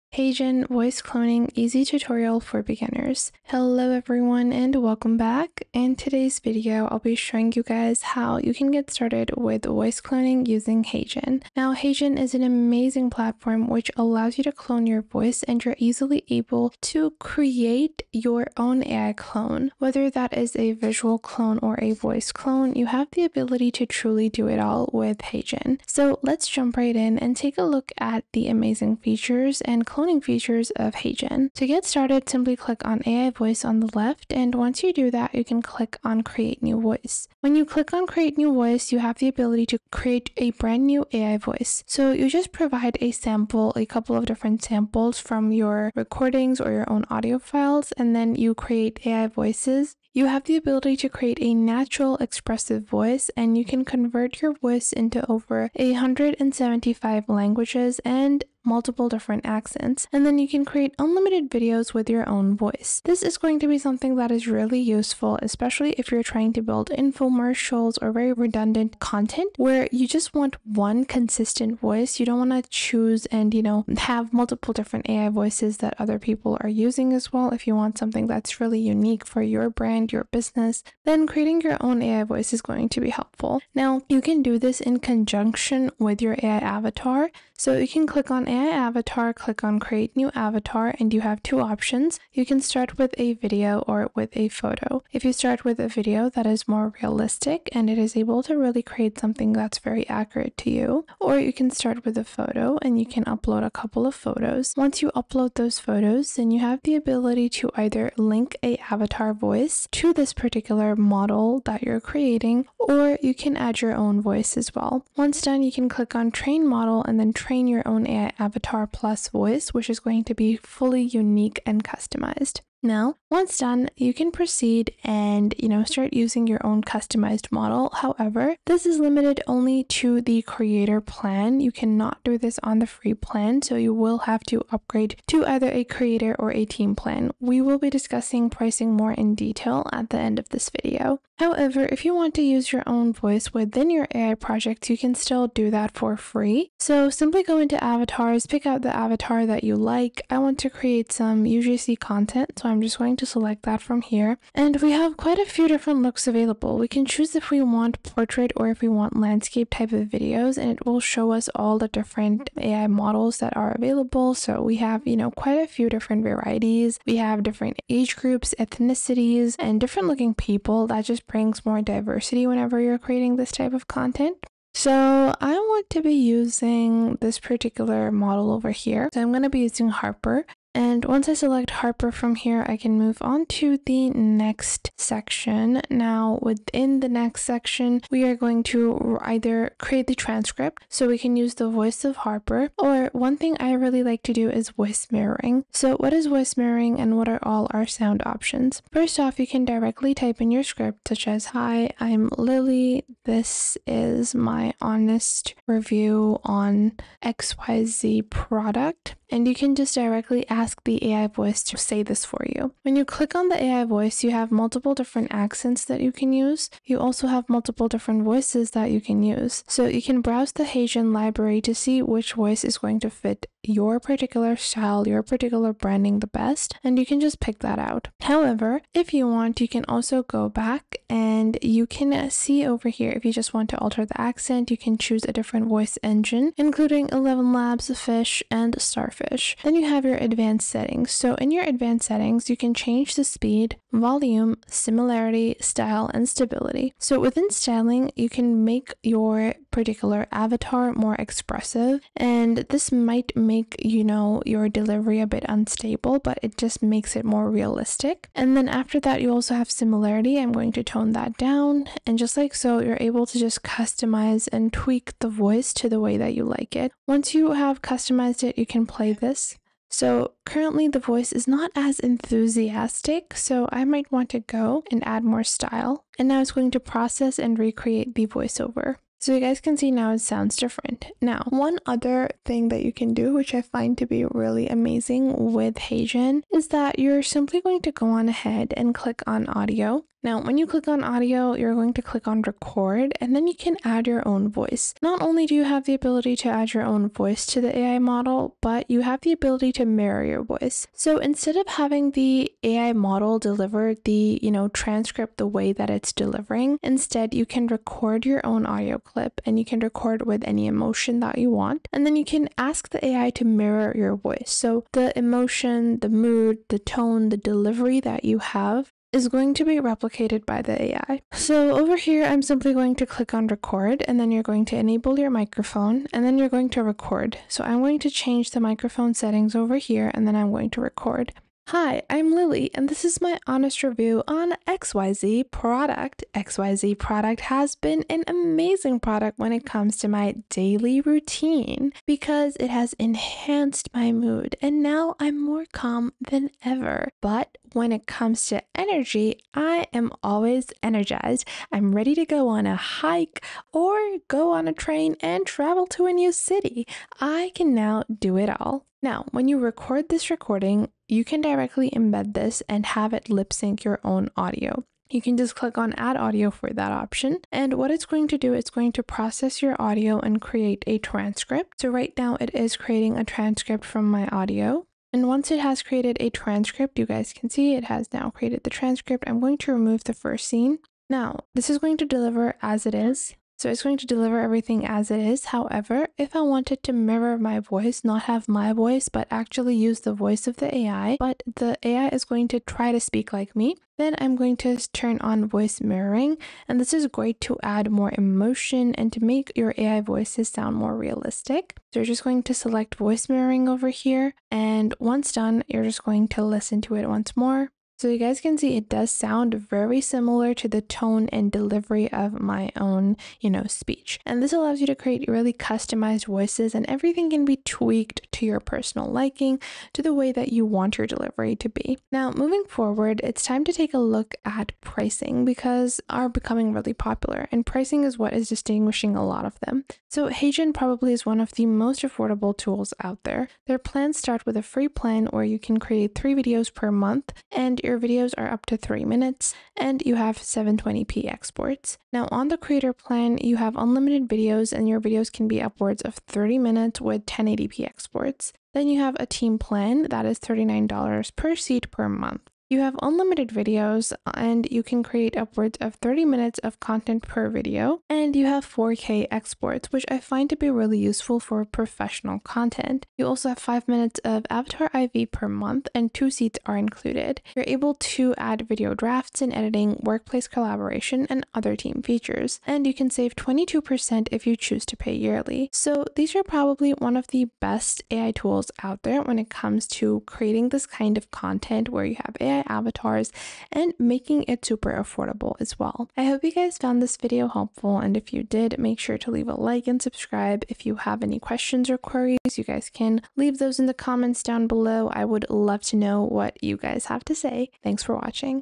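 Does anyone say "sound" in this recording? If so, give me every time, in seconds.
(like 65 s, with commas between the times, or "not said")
197 s, 280 s, 400 s, 409 s.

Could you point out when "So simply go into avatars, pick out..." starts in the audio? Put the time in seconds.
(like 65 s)
146 s.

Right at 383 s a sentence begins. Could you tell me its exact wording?
So it's going to deliver everything as it is.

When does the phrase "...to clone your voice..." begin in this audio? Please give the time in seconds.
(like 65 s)
14 s.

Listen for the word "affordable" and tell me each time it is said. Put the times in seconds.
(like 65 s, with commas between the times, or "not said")
432 s, 484 s.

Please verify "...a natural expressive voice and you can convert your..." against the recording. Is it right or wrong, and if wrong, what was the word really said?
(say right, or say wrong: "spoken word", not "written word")
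right.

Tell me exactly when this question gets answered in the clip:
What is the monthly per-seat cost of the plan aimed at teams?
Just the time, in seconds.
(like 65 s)
450 s.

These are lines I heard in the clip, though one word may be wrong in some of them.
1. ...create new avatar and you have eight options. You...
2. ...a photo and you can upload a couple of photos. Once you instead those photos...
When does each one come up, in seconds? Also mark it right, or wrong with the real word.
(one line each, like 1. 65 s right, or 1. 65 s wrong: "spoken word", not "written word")
1. 89 s wrong: "two", not "eight"
2. 102 s wrong: "upload", not "instead".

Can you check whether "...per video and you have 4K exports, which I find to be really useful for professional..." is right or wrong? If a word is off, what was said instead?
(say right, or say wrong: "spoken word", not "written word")
right.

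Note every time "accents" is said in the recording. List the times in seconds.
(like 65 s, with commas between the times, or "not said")
59 s, 215 s, 234 s.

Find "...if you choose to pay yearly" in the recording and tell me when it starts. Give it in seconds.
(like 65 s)
474 s.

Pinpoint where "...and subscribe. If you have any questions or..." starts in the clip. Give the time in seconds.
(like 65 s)
489 s.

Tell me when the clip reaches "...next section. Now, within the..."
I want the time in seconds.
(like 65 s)
184 s.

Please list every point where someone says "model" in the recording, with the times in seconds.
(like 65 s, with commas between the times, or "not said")
110 s, 116 s, 127 s, 162 s, 178 s, 297 s, 302 s.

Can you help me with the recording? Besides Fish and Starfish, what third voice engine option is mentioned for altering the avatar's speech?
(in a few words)
11 Labs.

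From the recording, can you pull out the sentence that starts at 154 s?
And we have quite a few different looks available.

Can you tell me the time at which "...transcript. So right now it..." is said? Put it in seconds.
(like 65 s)
370 s.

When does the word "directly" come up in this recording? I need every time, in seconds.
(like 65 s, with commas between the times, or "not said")
199 s, 209 s, 361 s.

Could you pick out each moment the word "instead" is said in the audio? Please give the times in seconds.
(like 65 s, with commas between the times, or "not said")
301 s, 306 s.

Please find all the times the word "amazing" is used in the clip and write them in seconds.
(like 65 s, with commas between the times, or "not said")
12 s, 28 s, 284 s, 338 s.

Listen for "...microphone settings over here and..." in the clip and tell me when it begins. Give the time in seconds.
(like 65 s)
328 s.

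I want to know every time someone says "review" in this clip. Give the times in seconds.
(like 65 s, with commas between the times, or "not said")
205 s, 333 s.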